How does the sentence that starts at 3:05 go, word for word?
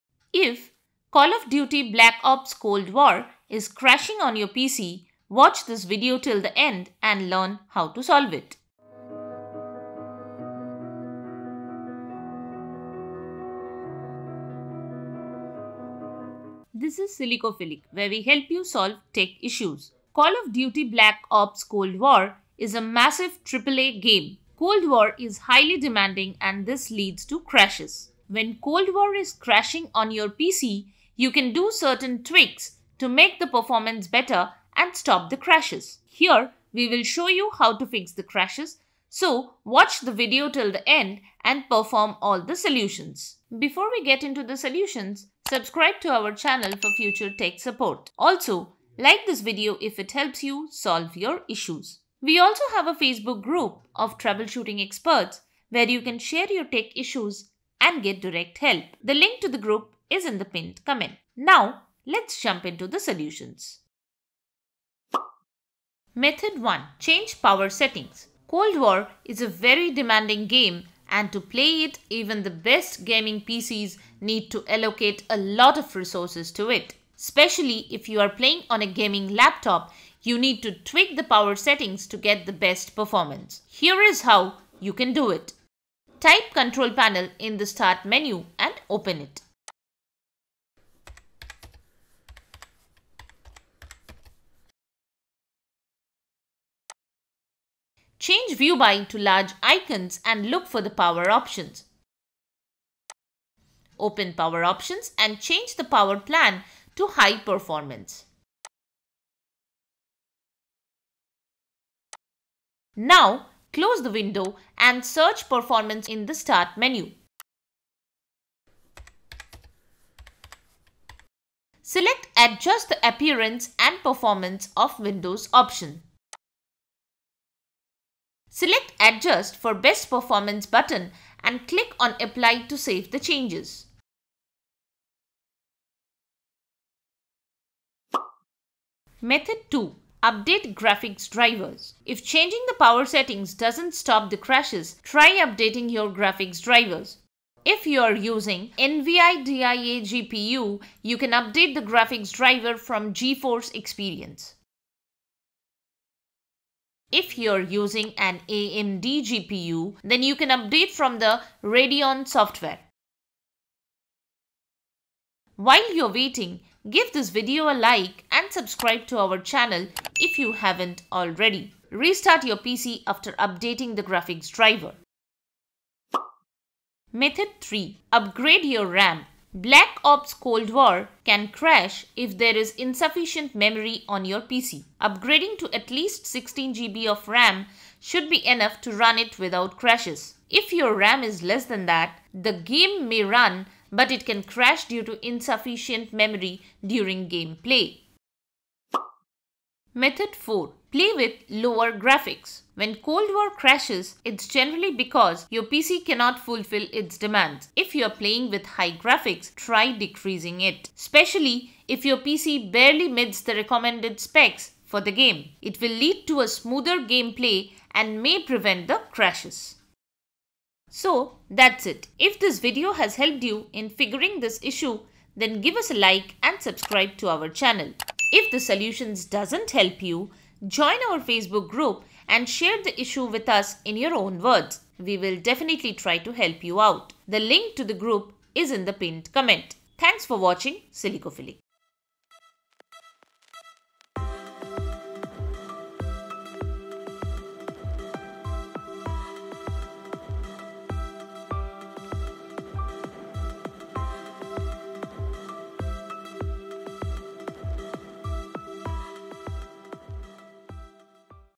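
Upgrading to at least 16 GB of RAM should be enough to run it without crashes.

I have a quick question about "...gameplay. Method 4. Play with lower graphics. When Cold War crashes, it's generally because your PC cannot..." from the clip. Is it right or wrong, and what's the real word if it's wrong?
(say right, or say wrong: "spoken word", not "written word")
right.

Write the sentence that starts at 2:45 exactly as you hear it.
While you're waiting, Give this video a like and subscribe to our channel if you haven't already.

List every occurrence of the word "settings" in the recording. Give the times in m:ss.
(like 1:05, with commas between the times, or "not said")
1:07, 1:21, 2:23.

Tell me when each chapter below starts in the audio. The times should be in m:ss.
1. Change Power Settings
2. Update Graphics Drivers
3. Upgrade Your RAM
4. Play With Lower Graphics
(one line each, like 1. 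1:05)
1. 1:05
2. 2:18
3. 2:56
4. 3:19.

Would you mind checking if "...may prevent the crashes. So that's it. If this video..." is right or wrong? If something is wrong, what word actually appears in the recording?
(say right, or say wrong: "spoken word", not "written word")
right.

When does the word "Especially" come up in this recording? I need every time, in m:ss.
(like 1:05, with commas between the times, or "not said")
1:17, 3:30.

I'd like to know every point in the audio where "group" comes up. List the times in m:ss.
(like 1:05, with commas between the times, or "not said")
0:53, 0:59, 3:51, 3:57.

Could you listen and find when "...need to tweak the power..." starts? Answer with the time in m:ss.
1:20.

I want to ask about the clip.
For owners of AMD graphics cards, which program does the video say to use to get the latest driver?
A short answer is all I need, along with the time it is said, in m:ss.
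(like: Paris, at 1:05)
Radeon software, at 2:41.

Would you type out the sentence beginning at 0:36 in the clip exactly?
Here, we will show you how to fix the crashes, so watch the video till the end and perform all the solutions.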